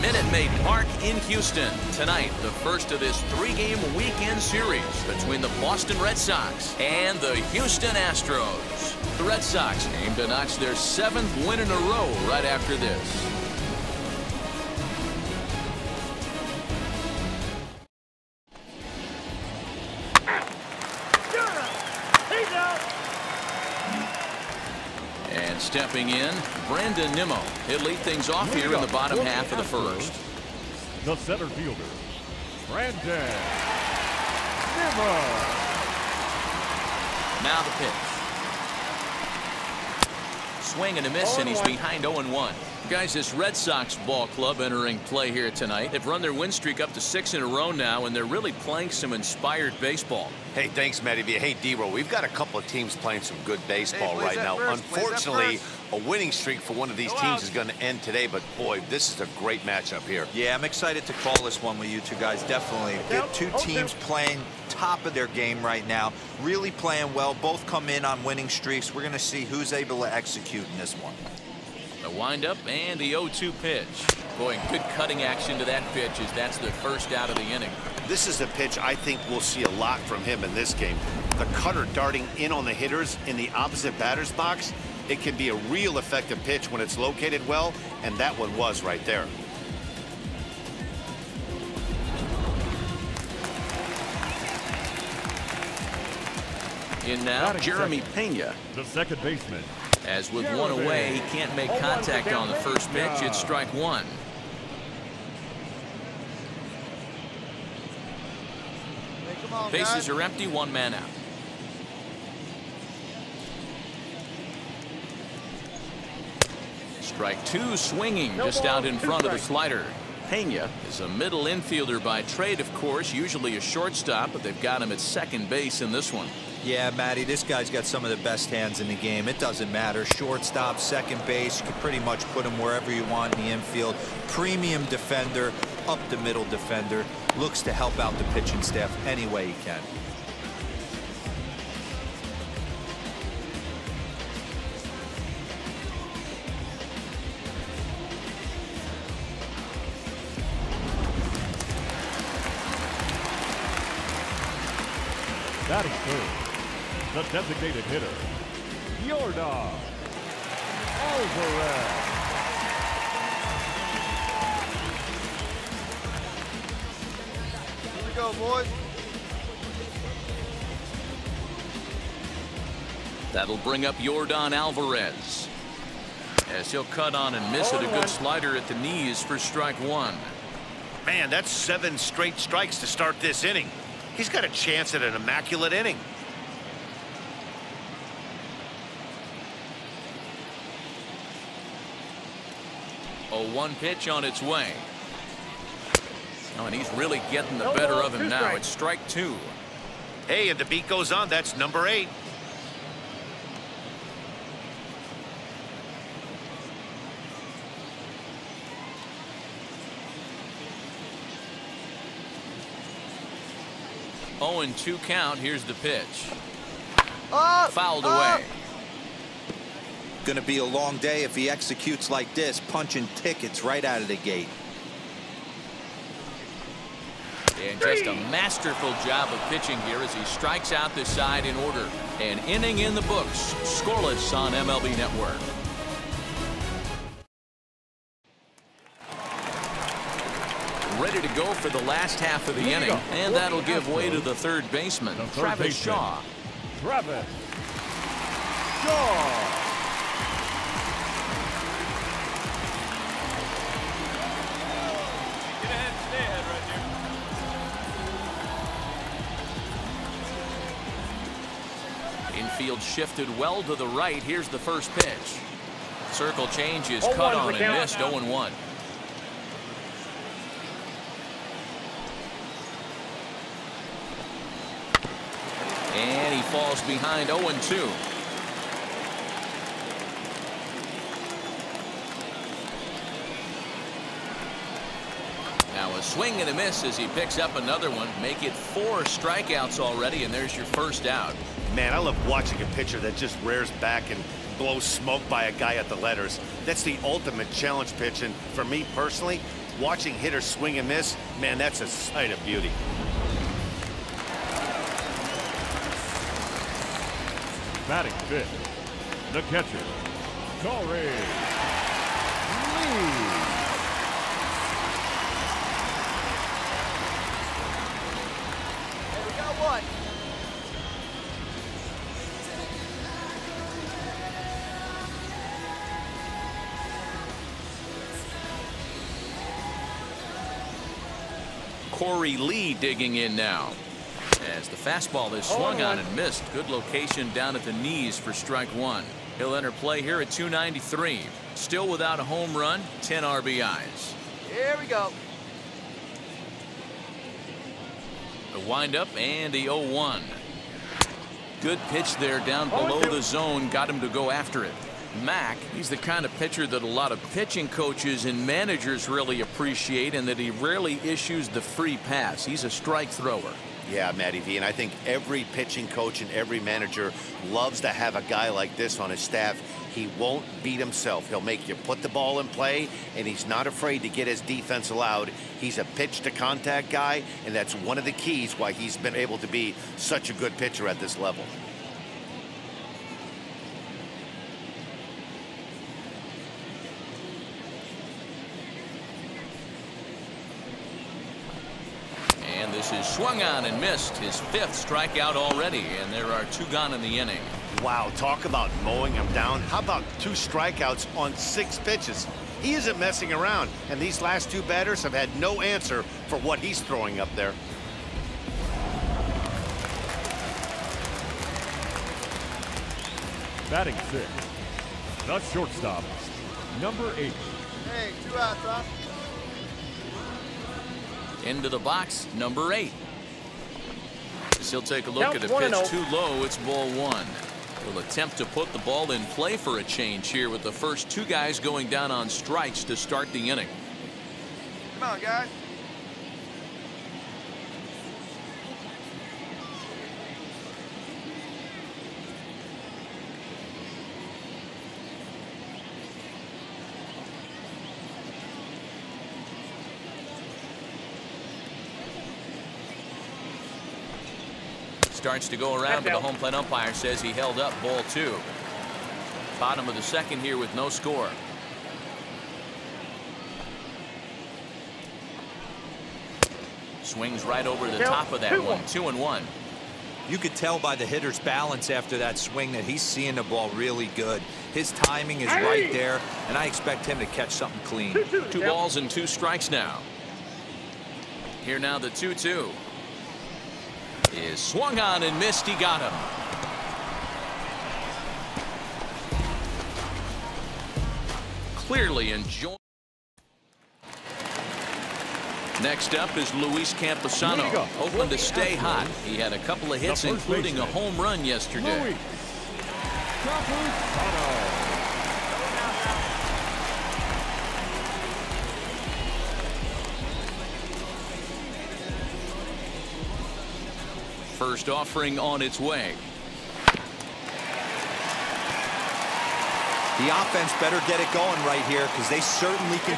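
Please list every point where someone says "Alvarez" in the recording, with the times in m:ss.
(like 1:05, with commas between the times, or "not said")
2:40, 2:54.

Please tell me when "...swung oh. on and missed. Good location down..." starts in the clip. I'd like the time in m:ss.
5:35.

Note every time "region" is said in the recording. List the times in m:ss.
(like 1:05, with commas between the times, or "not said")
not said.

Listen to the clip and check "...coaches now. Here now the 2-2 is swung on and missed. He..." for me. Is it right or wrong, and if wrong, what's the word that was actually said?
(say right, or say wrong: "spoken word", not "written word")
wrong: "strikes", not "coaches".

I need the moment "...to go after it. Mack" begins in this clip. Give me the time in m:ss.
5:54.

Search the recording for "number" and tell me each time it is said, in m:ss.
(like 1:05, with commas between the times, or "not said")
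3:21, 6:56, 7:02.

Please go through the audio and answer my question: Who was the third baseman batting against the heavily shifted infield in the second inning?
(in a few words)
Travis Shaw.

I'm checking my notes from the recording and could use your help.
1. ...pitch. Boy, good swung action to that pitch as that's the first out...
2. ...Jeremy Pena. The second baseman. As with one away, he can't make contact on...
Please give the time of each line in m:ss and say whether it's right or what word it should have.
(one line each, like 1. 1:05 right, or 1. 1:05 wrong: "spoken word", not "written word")
1. 1:13 wrong: "cutting", not "swung"
2. 1:37 right.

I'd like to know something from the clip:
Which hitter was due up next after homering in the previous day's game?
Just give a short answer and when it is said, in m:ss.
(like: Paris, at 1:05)
Luis Campusano, at 8:16.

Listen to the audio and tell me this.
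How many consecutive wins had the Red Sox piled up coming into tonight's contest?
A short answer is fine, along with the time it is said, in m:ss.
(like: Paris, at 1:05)
6, at 0:47.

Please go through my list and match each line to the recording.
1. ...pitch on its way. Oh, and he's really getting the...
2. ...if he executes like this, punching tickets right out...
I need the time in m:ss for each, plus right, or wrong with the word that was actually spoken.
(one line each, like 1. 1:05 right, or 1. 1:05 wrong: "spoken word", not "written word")
1. 3:13 right
2. 3:41 right.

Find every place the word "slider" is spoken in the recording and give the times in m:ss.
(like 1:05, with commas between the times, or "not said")
1:59, 2:58.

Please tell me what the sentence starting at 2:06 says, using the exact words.
Yeah, Matty, this guy's got some of the best hands in the game.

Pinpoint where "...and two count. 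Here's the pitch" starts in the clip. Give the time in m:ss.
3:34.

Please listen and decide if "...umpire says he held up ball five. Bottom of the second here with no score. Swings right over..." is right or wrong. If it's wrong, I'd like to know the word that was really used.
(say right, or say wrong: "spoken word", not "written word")
wrong: "two", not "five".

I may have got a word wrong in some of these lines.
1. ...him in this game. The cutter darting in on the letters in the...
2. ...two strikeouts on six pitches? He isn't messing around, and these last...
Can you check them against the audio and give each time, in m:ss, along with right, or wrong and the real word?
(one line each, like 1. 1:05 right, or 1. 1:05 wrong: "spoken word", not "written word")
1. 1:20 wrong: "hitters", not "letters"
2. 6:40 right.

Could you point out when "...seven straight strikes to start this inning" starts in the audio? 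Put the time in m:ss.
3:01.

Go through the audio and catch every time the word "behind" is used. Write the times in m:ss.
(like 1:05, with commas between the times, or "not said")
0:41, 4:36.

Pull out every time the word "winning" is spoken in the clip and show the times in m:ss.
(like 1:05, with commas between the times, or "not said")
0:55, 1:08.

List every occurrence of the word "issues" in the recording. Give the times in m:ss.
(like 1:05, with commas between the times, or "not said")
6:01.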